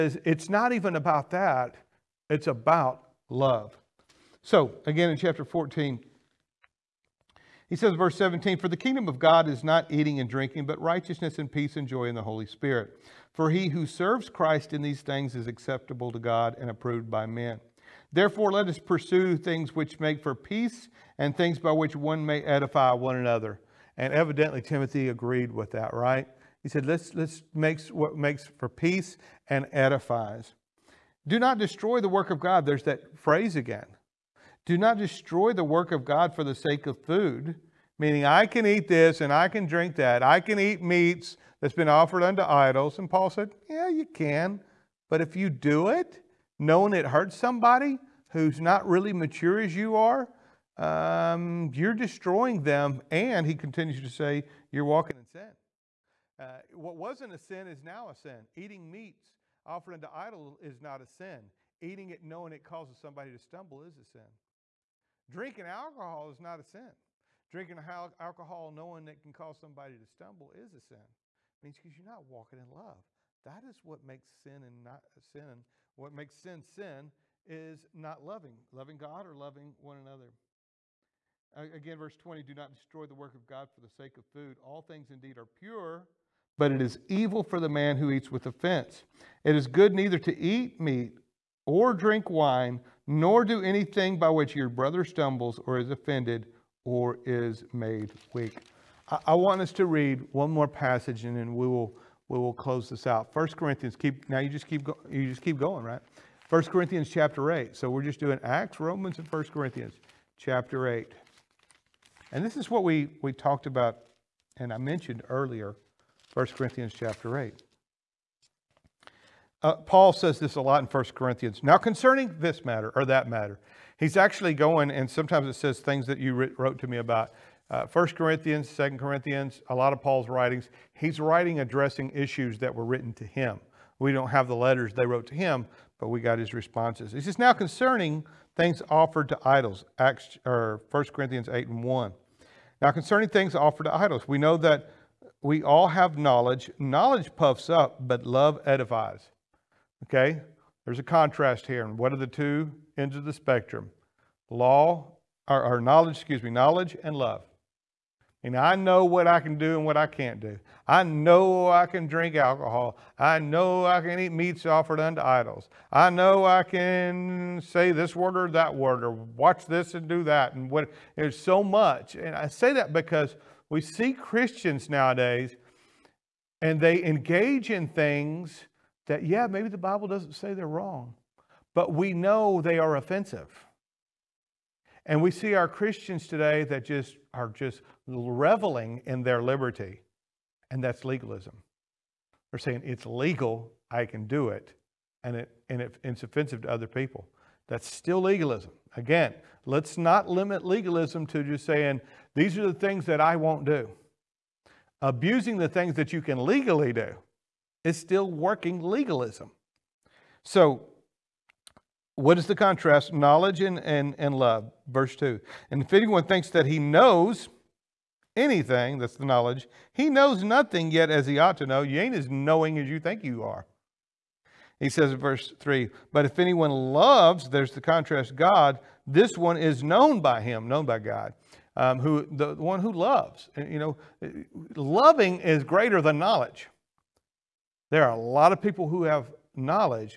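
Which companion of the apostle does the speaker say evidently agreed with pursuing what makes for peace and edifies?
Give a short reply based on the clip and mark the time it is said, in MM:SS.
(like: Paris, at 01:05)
Timothy, at 00:24.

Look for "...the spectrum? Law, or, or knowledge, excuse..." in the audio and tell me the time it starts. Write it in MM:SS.
02:33.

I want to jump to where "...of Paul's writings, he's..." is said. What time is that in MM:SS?
02:09.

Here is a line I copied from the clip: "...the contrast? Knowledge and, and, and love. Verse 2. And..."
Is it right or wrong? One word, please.
right.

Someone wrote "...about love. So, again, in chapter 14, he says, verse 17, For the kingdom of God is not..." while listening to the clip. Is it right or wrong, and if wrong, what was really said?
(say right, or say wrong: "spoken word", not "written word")
right.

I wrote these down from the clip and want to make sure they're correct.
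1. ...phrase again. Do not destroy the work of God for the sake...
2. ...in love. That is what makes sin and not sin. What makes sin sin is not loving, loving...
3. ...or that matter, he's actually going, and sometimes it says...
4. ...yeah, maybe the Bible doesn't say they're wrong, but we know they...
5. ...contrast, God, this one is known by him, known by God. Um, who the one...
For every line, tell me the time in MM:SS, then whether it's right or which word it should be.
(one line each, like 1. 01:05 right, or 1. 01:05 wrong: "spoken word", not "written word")
1. 00:33 right
2. 01:12 right
3. 02:02 right
4. 02:59 right
5. 03:47 right.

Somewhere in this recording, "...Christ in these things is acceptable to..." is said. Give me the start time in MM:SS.
00:14.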